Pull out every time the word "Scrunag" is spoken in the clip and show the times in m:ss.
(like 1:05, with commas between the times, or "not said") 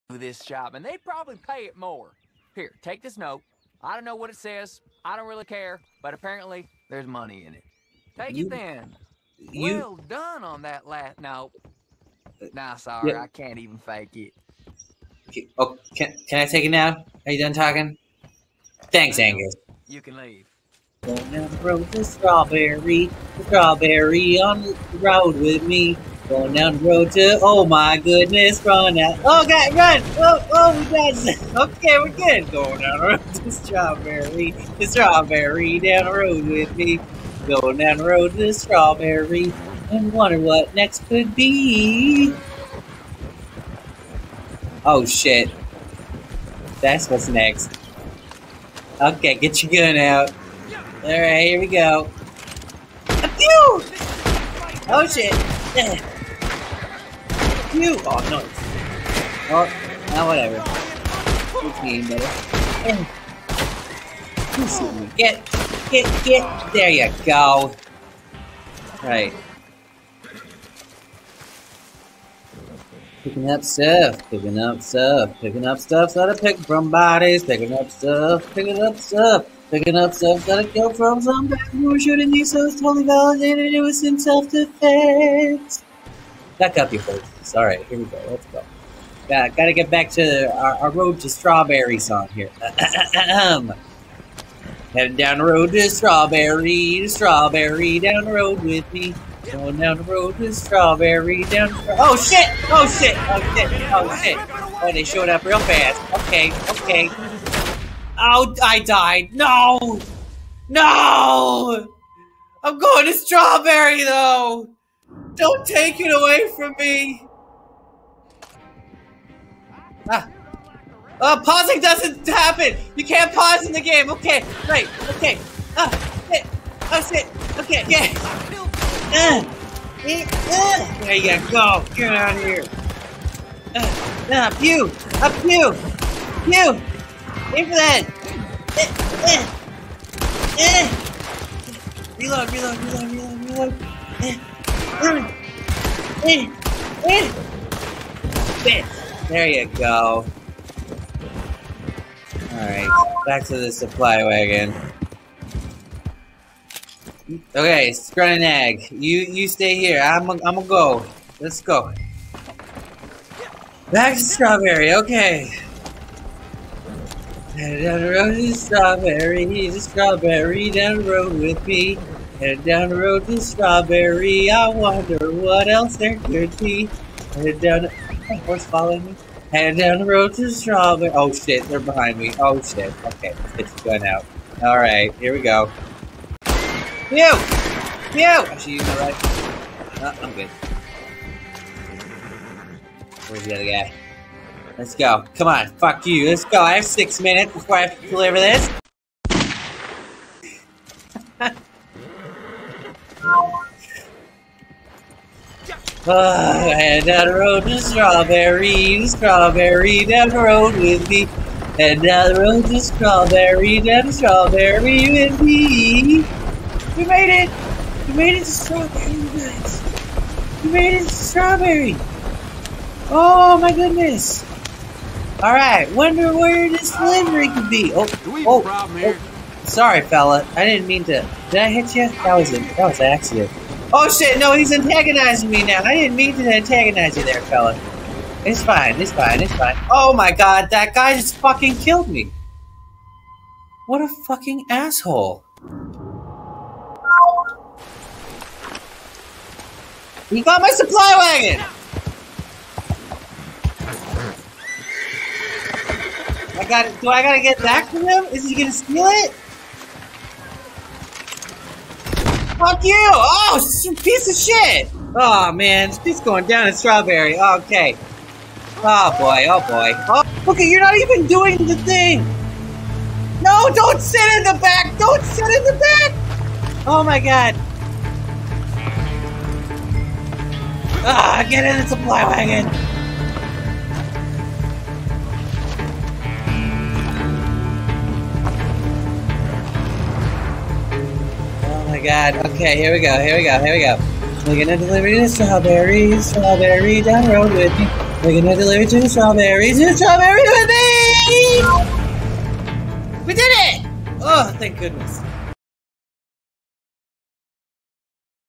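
2:37.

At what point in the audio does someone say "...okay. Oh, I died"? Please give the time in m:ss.
1:46.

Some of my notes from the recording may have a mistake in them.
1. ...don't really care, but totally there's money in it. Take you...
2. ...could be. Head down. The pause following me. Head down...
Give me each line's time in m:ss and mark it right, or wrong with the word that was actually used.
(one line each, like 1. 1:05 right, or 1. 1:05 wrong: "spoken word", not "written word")
1. 0:05 wrong: "apparently", not "totally"
2. 2:56 wrong: "horse", not "pause".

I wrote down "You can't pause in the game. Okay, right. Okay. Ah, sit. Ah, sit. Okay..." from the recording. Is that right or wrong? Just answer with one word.
right.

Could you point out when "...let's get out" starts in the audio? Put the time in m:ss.
3:03.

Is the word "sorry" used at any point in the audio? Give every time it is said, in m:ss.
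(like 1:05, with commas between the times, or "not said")
0:12, 3:49.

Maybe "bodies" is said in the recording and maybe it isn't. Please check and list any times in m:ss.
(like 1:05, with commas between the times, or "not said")
1:16.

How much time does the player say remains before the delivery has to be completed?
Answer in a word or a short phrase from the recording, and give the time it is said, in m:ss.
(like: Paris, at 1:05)
6 minutes, at 3:16.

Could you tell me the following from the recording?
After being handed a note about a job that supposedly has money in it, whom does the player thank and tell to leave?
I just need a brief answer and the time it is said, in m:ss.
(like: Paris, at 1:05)
Angus, at 0:19.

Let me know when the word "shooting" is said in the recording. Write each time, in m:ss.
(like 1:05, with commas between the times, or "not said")
1:21.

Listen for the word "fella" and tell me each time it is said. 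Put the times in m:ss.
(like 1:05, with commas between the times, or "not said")
3:50, 3:57.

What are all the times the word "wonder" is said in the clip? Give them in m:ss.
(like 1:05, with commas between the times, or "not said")
0:40, 2:54, 3:45.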